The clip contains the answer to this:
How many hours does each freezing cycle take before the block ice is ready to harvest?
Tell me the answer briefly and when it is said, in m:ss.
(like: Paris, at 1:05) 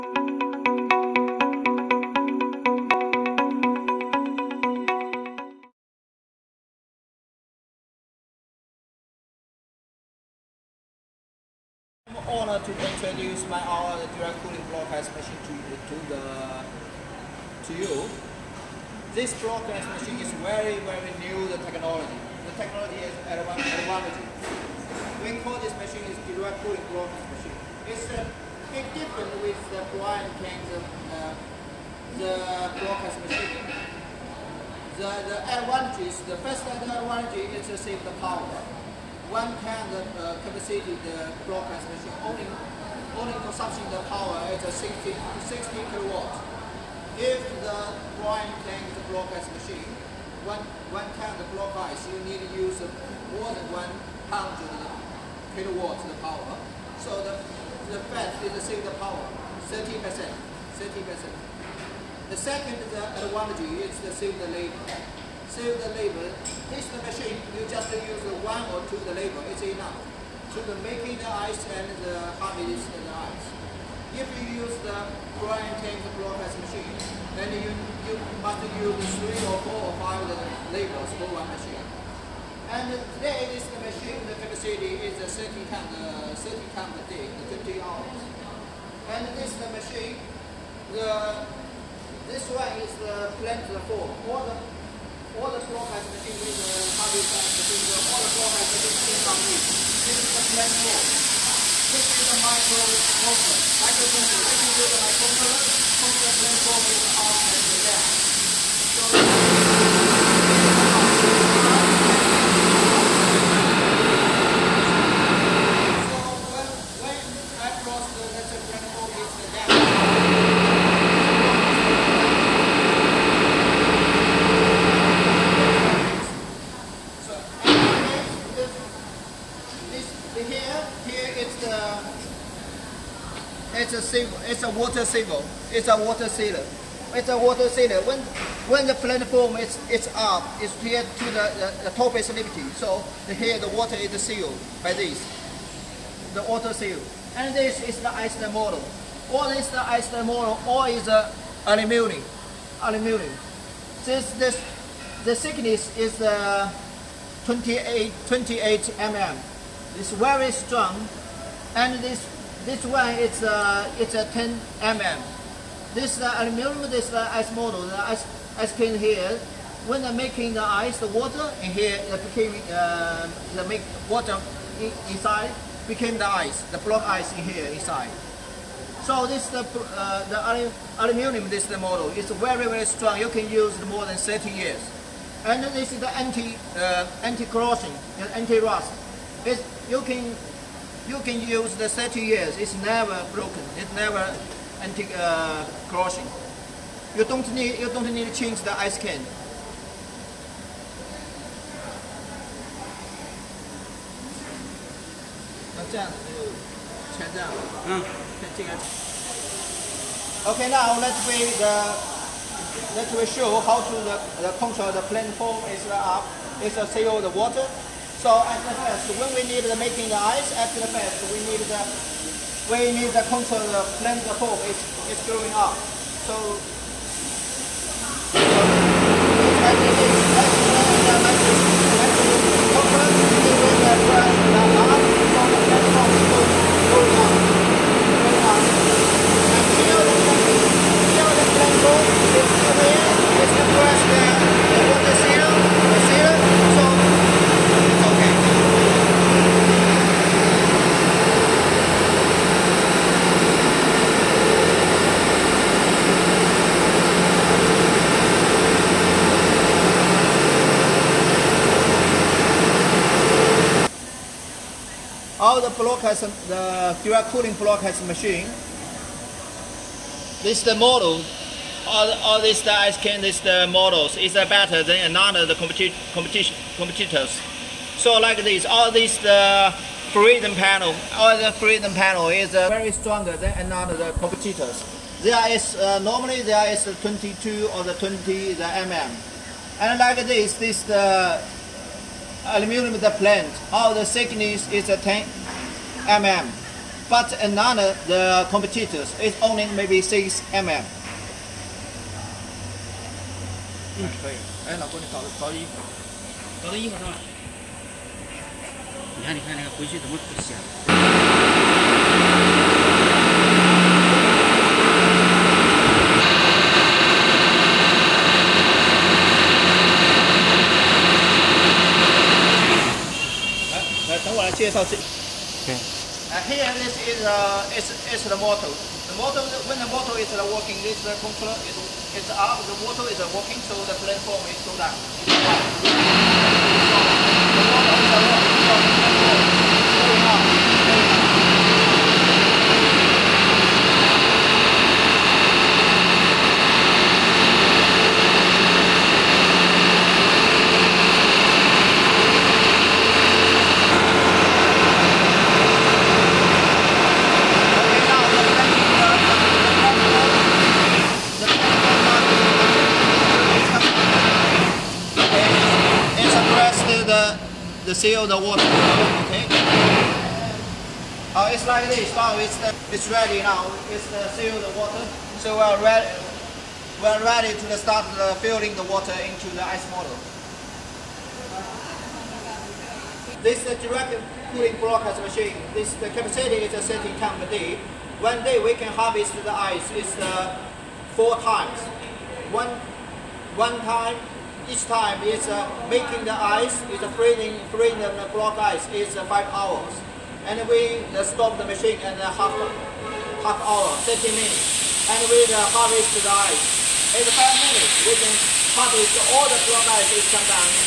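5 hours, at 6:39.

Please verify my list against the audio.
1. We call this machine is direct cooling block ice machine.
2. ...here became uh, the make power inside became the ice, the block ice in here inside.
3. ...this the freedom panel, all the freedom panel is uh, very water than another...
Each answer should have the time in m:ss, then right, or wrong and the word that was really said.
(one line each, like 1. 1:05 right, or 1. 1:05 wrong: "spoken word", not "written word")
1. 0:25 right
2. 2:51 wrong: "water", not "power"
3. 4:38 wrong: "stronger", not "water".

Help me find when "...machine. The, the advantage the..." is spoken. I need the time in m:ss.
0:33.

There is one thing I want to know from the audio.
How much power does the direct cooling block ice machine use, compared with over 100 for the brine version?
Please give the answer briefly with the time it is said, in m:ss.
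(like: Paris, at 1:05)
60 kilowatts, at 0:45.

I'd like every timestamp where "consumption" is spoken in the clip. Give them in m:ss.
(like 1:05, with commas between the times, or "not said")
0:43.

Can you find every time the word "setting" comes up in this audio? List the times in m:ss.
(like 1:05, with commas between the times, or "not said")
6:26.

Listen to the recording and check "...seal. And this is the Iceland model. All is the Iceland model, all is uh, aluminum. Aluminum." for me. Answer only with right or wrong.
right.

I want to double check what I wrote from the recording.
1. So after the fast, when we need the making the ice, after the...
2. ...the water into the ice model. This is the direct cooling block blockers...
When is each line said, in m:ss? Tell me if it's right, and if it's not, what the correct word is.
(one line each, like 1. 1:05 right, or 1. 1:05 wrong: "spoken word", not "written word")
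1. 3:38 right
2. 6:18 right.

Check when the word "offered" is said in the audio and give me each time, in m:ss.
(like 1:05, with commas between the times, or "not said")
not said.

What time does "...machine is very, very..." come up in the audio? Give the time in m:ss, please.
0:19.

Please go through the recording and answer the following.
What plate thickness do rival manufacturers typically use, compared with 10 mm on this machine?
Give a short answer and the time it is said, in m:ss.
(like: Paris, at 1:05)
6 mm, at 5:00.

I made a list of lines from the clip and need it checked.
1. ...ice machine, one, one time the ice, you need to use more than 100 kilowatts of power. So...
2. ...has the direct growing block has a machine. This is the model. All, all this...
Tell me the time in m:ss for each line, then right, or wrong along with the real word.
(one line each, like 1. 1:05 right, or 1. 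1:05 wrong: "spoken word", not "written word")
1. 0:49 right
2. 4:26 wrong: "cooling", not "growing".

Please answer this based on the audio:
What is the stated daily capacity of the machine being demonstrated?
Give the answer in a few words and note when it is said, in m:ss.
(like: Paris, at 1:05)
30 ton, at 1:25.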